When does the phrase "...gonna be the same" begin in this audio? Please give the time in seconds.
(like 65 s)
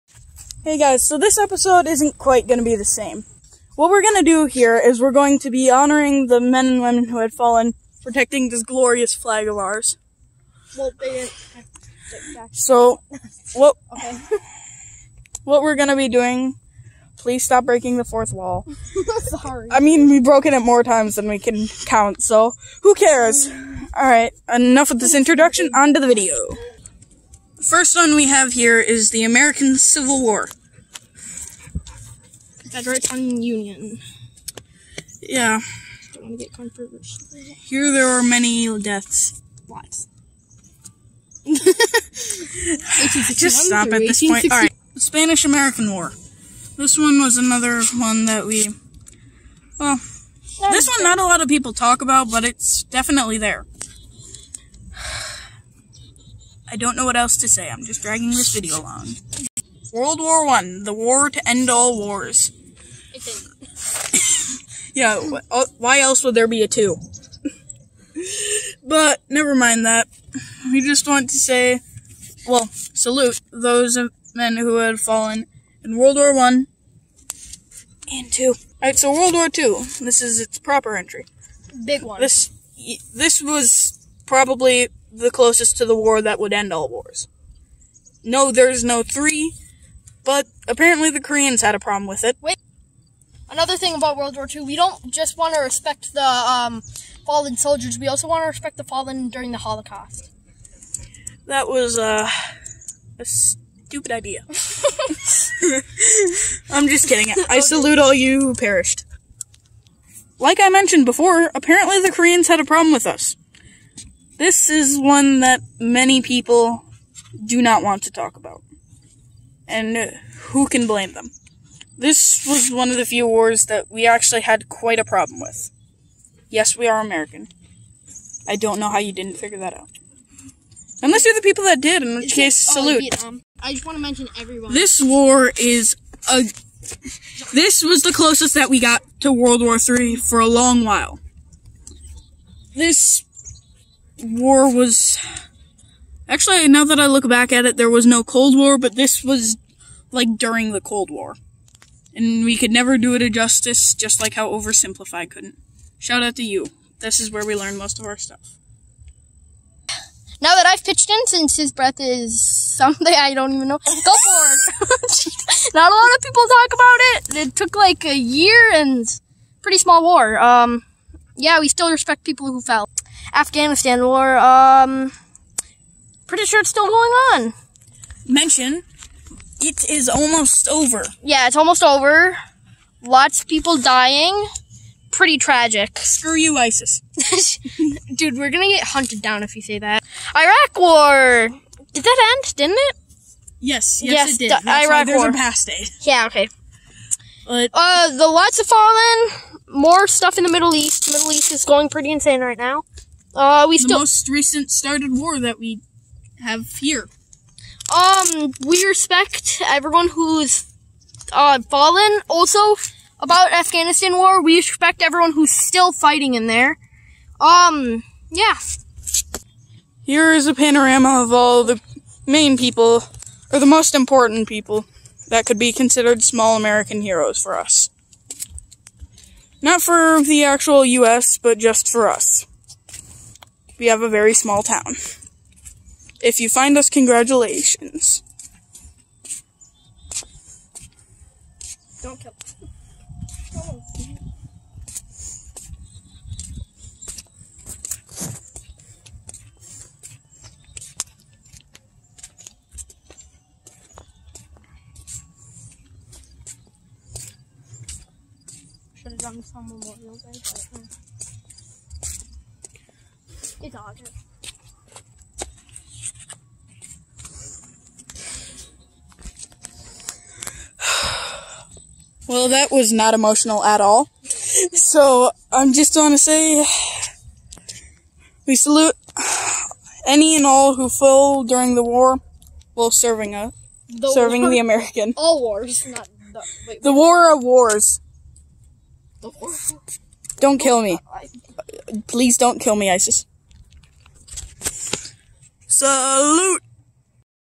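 2 s.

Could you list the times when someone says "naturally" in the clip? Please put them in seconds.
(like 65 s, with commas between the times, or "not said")
not said.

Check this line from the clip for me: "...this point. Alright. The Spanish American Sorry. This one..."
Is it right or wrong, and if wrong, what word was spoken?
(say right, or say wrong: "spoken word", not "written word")
wrong: "War", not "Sorry".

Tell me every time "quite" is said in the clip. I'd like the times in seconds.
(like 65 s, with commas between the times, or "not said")
2 s, 124 s.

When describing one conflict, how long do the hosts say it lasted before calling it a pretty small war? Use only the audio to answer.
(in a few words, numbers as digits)
a year.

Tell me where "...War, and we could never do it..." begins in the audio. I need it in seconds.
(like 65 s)
151 s.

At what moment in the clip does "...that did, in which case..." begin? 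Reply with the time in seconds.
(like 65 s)
131 s.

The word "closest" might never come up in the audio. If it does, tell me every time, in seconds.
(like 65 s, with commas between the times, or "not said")
85 s, 138 s.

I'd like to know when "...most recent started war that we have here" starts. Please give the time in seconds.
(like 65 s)
203 s.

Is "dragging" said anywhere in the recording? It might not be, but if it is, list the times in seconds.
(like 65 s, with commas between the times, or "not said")
58 s.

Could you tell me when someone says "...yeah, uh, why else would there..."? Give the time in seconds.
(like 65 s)
64 s.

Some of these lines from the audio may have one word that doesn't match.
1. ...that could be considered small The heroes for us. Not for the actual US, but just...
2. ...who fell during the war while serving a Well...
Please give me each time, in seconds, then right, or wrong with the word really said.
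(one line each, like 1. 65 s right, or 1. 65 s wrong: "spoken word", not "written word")
1. 225 s wrong: "American", not "The"
2. 280 s wrong: "The", not "Well".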